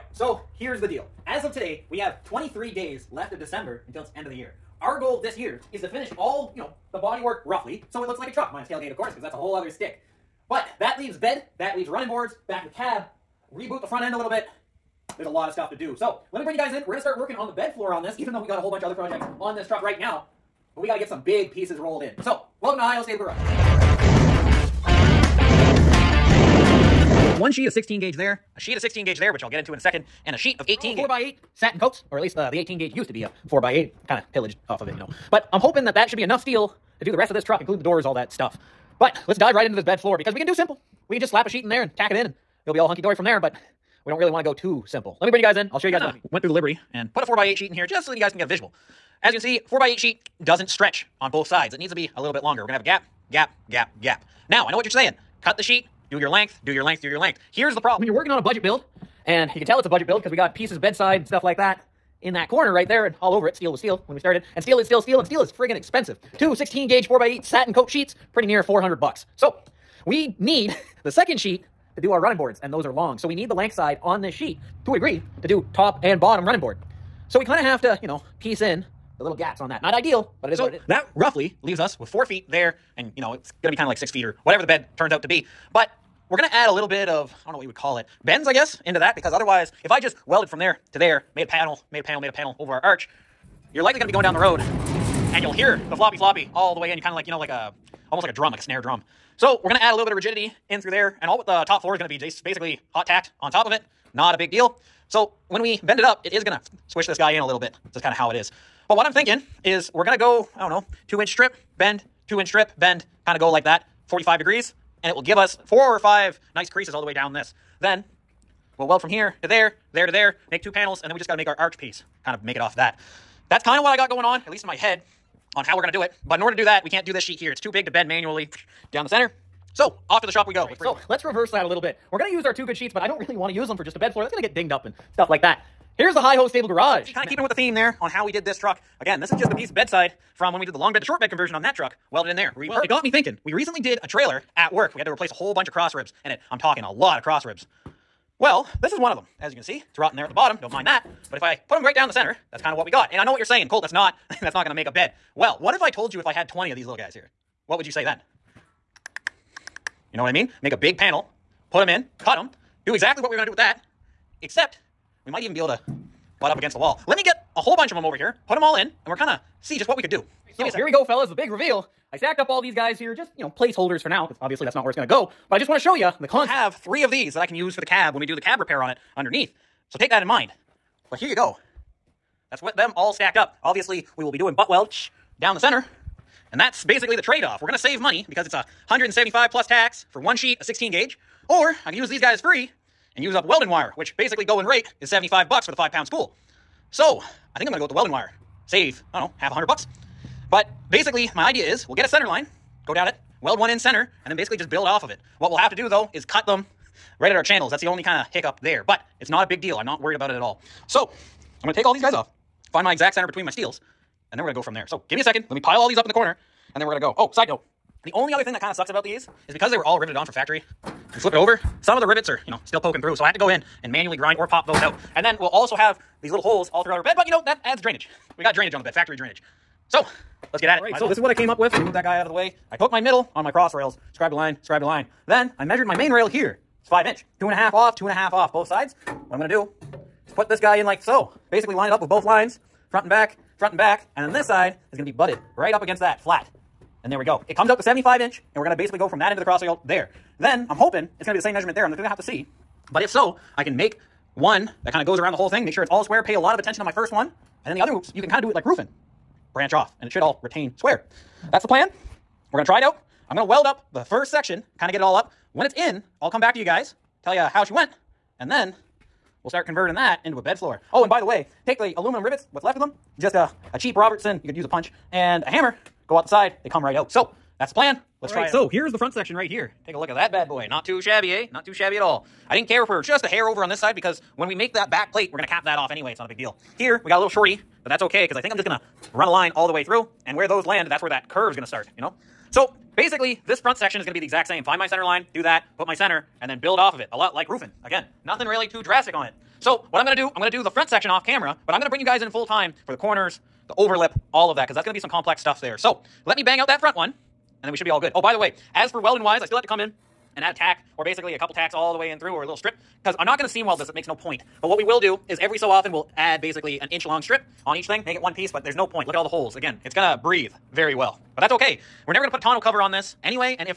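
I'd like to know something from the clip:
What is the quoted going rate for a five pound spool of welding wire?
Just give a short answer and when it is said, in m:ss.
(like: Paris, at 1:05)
75 bucks, at 3:15.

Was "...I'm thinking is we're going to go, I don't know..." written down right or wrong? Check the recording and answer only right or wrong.
right.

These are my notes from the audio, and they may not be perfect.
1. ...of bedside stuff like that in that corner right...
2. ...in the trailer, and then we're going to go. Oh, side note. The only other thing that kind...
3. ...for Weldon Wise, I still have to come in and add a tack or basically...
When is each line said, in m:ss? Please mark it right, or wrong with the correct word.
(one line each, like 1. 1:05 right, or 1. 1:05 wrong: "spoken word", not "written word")
1. 1:00 right
2. 3:36 wrong: "corner", not "trailer"
3. 5:08 right.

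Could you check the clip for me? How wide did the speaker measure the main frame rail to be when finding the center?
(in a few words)
5 inch.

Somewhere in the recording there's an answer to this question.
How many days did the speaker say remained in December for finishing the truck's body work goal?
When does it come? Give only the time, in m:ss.
0:02.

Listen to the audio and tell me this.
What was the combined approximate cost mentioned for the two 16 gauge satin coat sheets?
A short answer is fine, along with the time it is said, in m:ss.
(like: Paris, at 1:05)
400 bucks, at 1:08.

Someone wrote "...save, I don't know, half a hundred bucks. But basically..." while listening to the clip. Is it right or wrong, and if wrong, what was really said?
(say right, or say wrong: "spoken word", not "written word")
right.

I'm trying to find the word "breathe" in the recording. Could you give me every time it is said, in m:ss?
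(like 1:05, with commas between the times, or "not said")
5:20.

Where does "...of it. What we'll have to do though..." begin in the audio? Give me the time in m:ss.
3:25.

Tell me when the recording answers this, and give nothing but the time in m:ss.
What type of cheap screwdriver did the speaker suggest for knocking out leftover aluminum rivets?
4:33.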